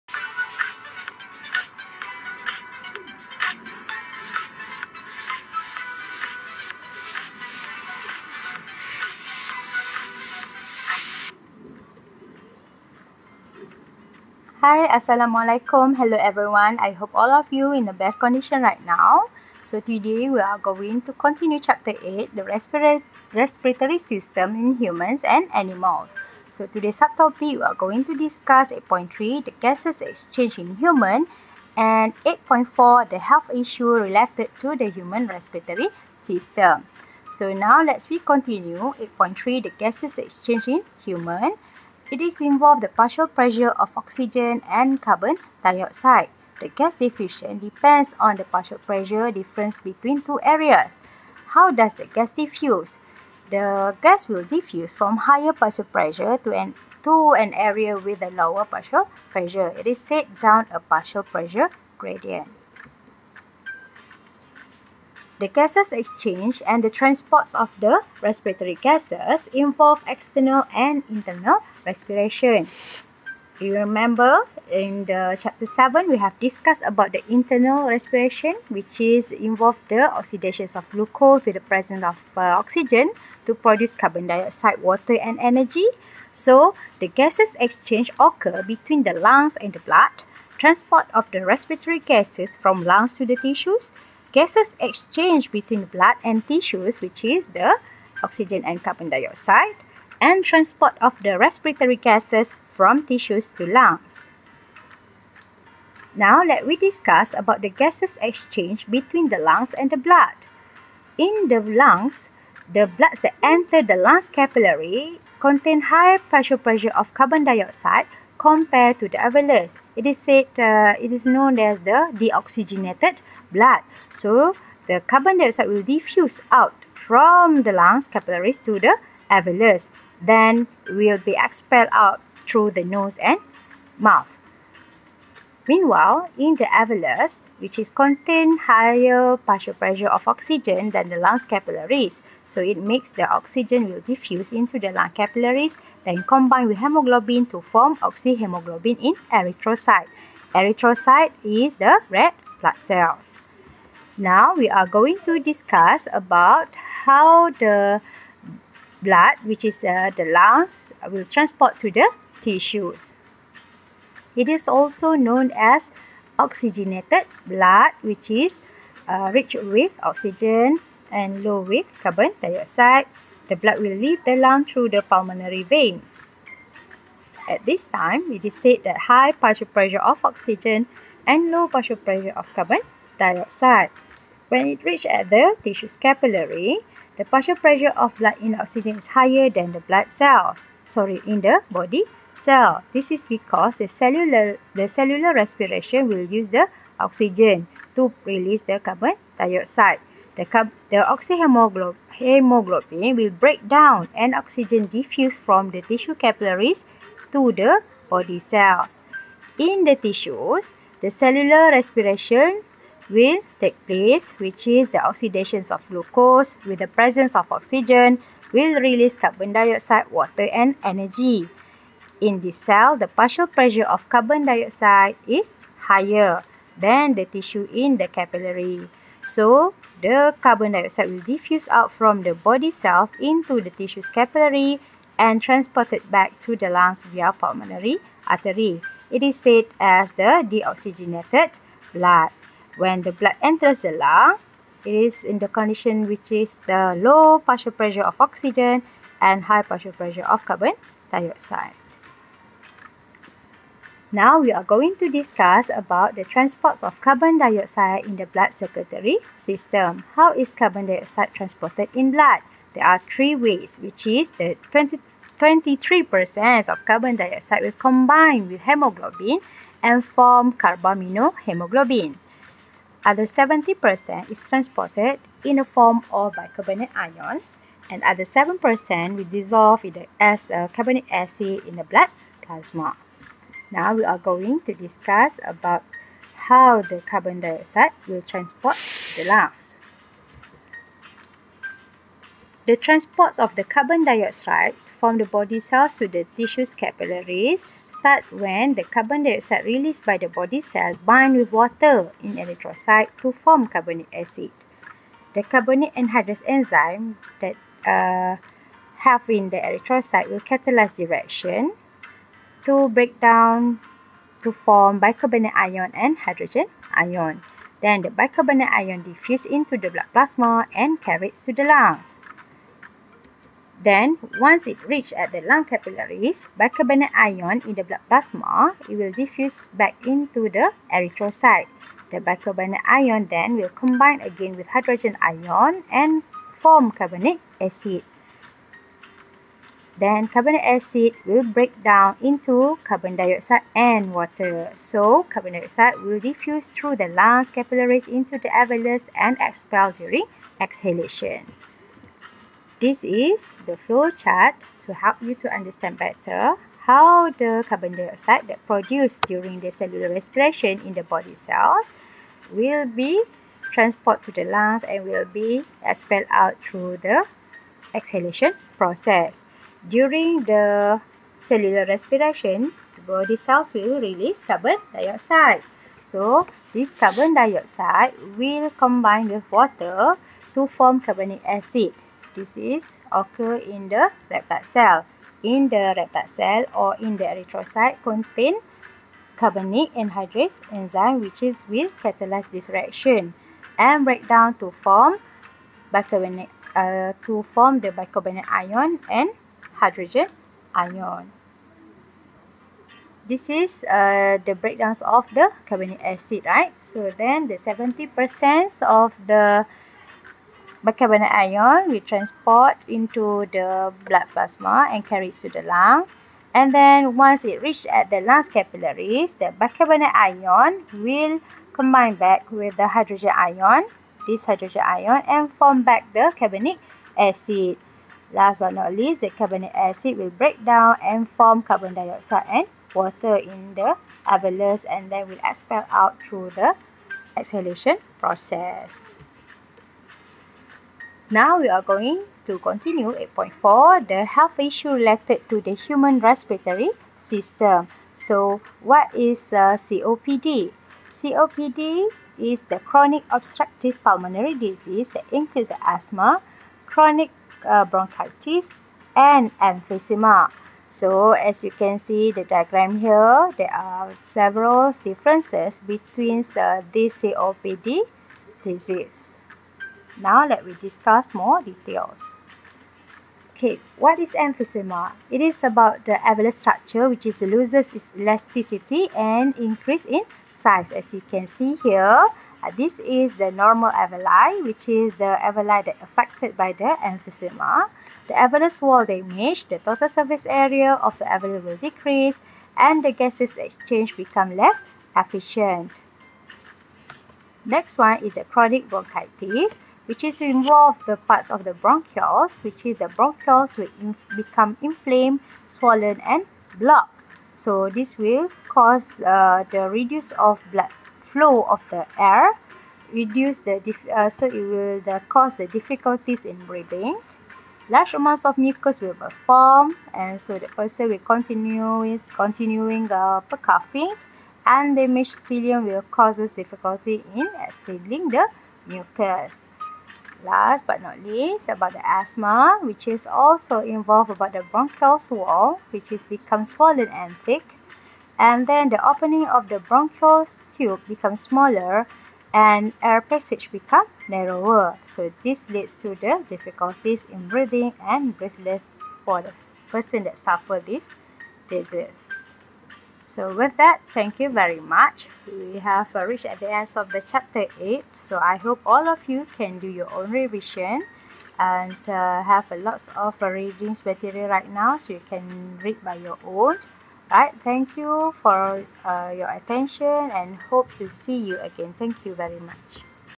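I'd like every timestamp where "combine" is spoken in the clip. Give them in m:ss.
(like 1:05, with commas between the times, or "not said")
2:26, 4:27, 5:33, 6:18, 7:01.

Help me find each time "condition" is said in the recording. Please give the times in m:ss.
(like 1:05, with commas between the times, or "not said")
0:18, 4:05.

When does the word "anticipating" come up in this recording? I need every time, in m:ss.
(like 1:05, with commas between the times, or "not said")
not said.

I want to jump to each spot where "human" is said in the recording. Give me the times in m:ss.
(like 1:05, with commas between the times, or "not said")
0:24, 0:30, 0:34, 0:41, 7:25.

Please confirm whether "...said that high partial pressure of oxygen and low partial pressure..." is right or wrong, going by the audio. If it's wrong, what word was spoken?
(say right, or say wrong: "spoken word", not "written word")
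right.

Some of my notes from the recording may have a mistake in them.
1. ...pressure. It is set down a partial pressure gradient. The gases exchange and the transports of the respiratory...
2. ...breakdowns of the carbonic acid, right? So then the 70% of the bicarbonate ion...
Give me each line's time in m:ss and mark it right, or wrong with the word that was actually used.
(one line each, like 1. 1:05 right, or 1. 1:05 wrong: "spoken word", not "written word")
1. 0:59 right
2. 6:44 right.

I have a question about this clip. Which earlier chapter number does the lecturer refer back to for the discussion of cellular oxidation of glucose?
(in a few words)
7.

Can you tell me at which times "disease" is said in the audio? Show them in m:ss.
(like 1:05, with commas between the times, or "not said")
7:34, 7:48, 9:11.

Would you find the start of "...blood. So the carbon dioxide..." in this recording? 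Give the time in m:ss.
2:03.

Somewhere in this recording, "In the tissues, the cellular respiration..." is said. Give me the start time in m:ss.
3:29.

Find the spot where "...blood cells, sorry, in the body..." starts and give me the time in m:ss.
3:09.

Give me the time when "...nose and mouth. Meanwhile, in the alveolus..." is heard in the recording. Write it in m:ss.
2:12.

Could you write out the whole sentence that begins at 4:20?
How is carbon dioxide transported in blood?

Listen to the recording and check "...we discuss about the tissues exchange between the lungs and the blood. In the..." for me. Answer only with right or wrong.
wrong.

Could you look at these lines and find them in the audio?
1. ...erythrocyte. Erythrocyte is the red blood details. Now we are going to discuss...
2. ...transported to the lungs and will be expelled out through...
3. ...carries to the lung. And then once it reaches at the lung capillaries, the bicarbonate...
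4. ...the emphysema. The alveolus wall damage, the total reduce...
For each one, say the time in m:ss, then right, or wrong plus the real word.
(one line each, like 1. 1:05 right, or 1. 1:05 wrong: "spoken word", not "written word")
1. 2:29 wrong: "cells", not "details"
2. 6:03 right
3. 6:55 right
4. 8:06 wrong: "surface", not "reduce".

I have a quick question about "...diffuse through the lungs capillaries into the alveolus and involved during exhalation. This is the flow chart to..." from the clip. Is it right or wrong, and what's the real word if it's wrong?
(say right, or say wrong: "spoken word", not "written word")
wrong: "expelled", not "involved".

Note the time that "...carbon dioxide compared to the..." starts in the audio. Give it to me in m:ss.
1:57.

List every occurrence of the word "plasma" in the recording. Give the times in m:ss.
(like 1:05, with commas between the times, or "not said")
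4:42, 5:20, 5:28, 6:54.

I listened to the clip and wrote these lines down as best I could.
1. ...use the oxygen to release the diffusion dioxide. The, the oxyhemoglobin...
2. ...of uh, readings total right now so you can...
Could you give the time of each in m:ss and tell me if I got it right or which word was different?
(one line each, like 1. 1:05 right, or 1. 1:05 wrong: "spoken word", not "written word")
1. 3:16 wrong: "carbon", not "diffusion"
2. 9:23 wrong: "material", not "total".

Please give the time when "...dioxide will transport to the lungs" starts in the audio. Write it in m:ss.
4:47.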